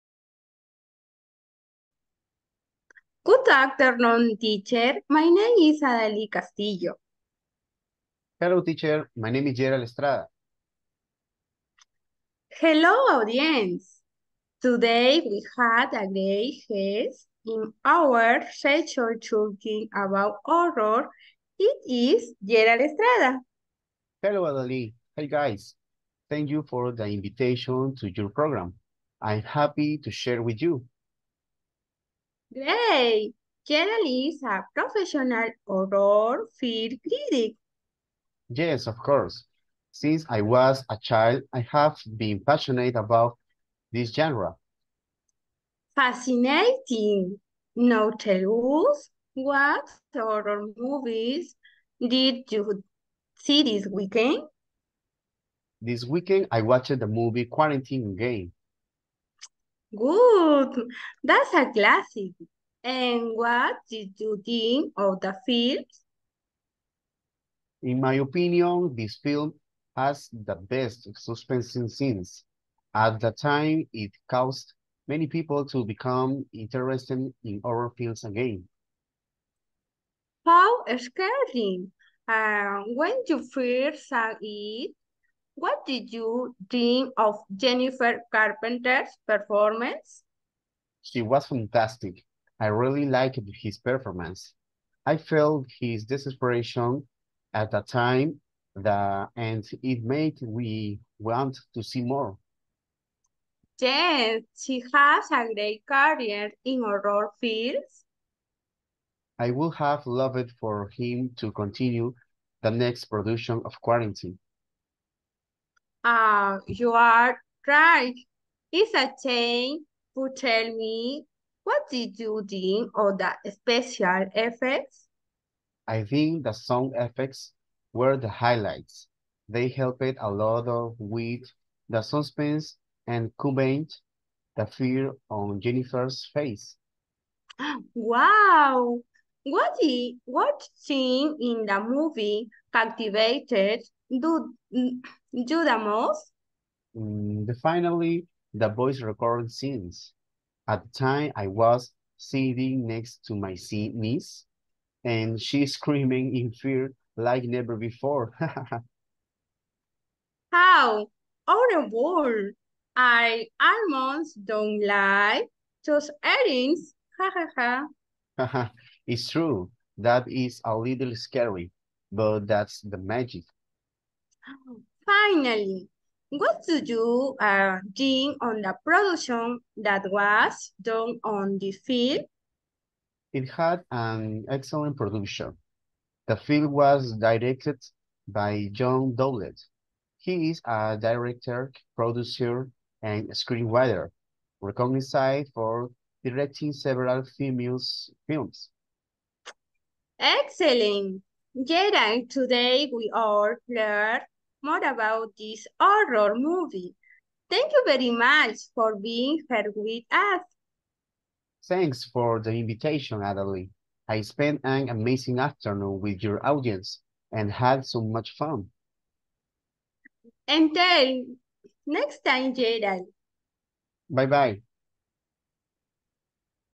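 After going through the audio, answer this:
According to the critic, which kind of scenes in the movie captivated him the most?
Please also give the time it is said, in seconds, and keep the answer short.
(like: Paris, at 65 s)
Voice recording scenes, at 148 s.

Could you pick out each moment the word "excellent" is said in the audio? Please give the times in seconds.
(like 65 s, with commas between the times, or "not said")
184 s, 200 s.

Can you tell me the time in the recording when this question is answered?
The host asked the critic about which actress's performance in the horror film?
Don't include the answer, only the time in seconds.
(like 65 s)
87 s.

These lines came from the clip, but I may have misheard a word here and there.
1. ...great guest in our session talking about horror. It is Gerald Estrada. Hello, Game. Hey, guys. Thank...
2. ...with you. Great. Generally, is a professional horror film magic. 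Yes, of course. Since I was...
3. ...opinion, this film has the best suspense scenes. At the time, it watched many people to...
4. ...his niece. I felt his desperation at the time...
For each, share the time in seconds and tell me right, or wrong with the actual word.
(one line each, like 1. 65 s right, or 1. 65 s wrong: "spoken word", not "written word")
1. 16 s wrong: "Adaly", not "Game"
2. 30 s wrong: "critic", not "magic"
3. 68 s wrong: "caused", not "watched"
4. 93 s wrong: "performance", not "niece".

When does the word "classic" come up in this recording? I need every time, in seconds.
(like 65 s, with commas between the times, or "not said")
61 s.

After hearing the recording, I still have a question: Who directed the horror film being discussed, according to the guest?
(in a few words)
John Dowdle.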